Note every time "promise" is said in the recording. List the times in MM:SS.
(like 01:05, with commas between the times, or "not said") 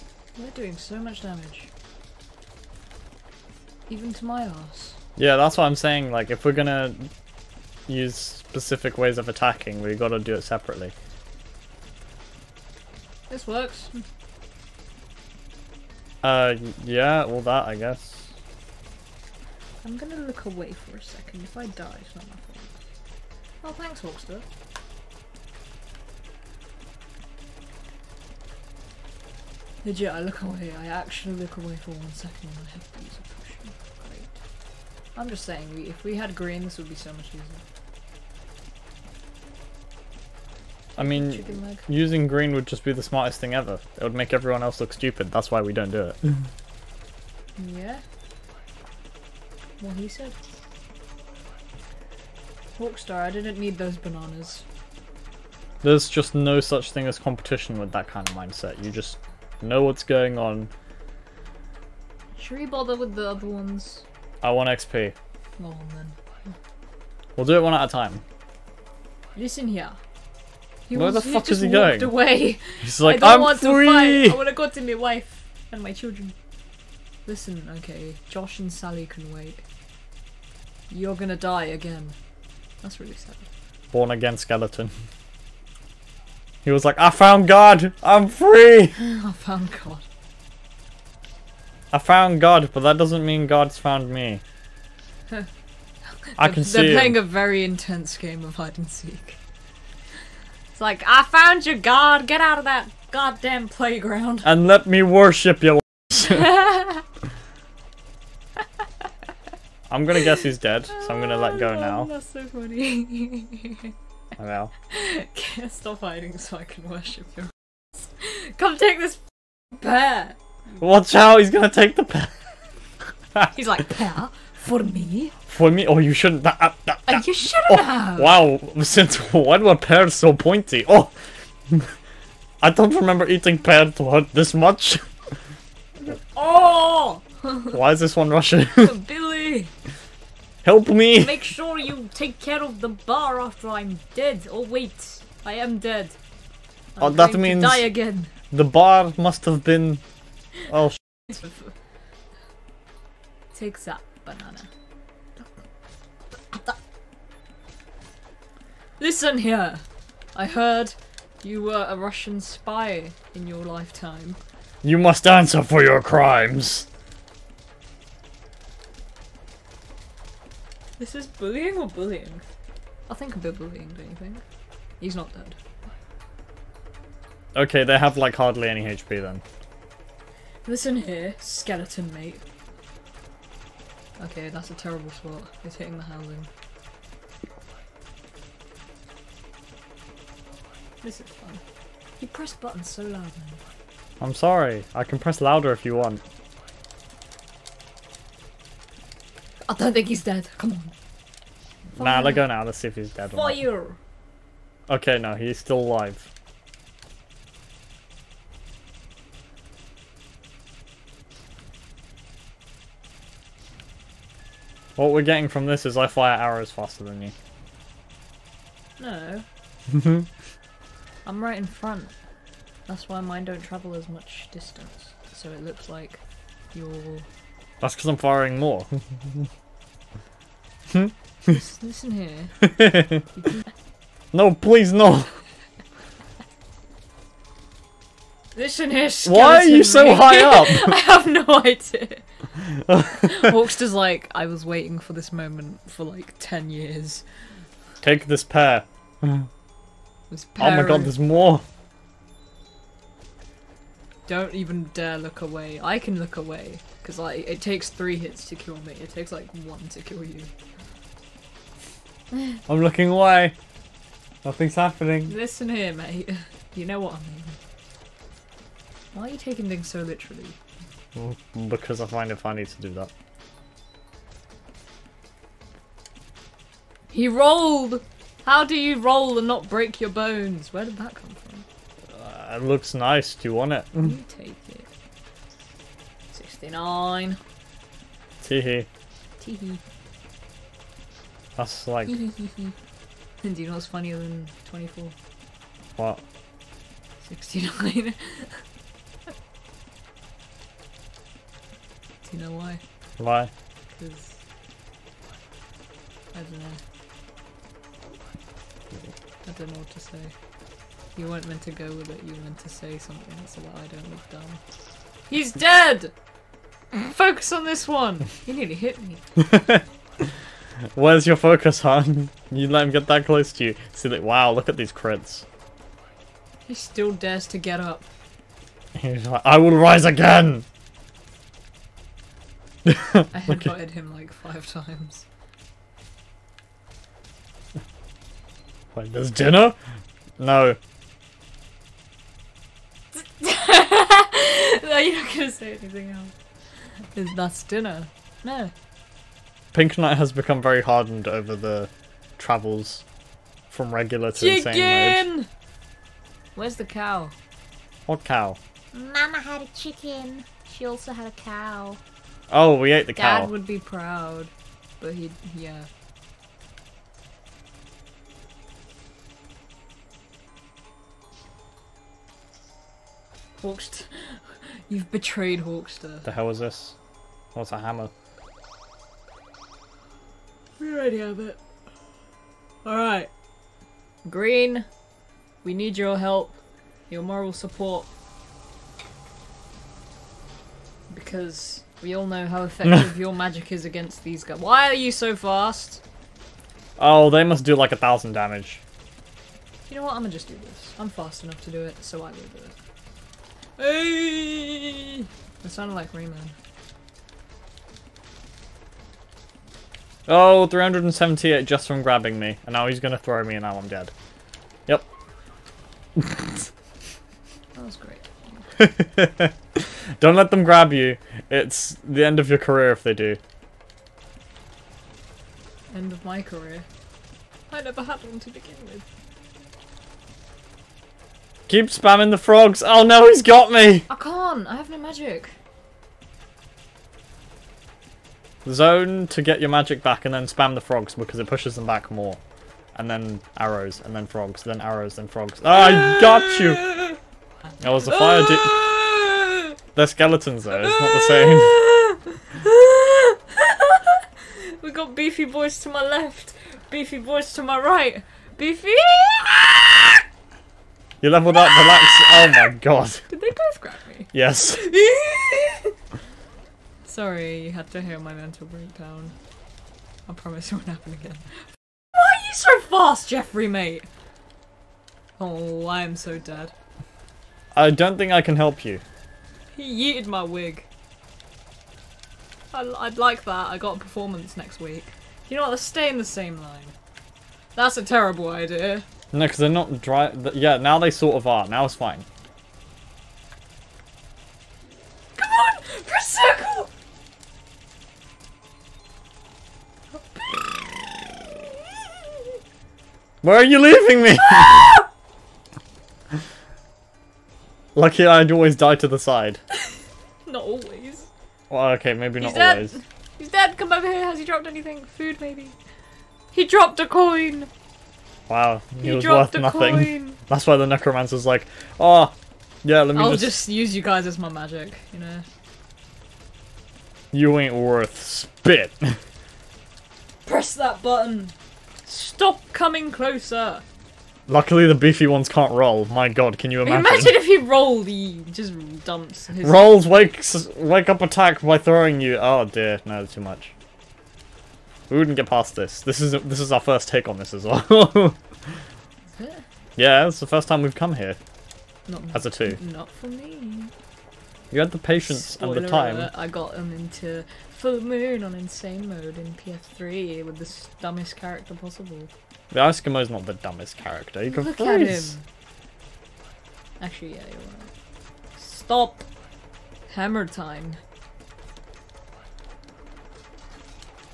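07:50.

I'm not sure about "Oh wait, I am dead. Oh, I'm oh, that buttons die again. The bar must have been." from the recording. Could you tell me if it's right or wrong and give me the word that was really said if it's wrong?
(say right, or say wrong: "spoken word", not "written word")
wrong: "means", not "buttons".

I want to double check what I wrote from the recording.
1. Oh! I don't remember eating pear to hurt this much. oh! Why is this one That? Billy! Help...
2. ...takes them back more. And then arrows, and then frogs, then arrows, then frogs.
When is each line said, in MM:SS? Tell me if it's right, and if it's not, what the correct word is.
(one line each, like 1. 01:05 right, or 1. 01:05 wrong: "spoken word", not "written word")
1. 02:10 wrong: "Russian", not "That"
2. 07:21 wrong: "pushes", not "takes".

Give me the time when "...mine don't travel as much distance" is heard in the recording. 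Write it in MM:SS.
03:43.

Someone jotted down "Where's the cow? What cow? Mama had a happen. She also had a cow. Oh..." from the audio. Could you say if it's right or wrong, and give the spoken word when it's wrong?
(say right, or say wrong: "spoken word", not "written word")
wrong: "chicken", not "happen".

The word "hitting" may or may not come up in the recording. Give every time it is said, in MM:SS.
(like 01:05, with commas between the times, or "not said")
03:05.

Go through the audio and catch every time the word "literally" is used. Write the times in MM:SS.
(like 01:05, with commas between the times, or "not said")
04:30.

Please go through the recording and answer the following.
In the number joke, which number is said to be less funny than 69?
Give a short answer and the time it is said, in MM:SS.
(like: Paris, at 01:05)
24, at 04:54.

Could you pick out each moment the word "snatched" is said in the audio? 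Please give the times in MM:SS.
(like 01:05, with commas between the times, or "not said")
not said.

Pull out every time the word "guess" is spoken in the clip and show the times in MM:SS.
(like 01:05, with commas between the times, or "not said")
00:17, 01:50.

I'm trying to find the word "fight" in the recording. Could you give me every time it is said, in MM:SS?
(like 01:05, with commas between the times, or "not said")
01:14.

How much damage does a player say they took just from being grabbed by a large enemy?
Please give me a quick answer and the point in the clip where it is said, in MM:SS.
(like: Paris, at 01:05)
378, at 06:50.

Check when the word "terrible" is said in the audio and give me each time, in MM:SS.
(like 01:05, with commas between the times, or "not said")
03:04, 08:08.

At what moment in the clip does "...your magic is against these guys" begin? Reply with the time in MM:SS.
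06:33.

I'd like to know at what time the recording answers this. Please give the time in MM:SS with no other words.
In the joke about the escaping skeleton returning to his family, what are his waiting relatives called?
01:18.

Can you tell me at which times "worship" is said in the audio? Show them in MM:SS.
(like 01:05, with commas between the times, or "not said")
01:45, 01:56.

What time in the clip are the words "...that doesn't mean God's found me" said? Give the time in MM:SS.
01:32.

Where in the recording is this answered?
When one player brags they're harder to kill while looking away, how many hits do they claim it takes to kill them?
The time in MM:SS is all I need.
04:17.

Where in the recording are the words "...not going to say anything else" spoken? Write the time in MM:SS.
05:45.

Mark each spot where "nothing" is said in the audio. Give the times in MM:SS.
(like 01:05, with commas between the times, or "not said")
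04:24, 08:39.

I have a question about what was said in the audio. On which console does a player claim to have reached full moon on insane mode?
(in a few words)
PS3.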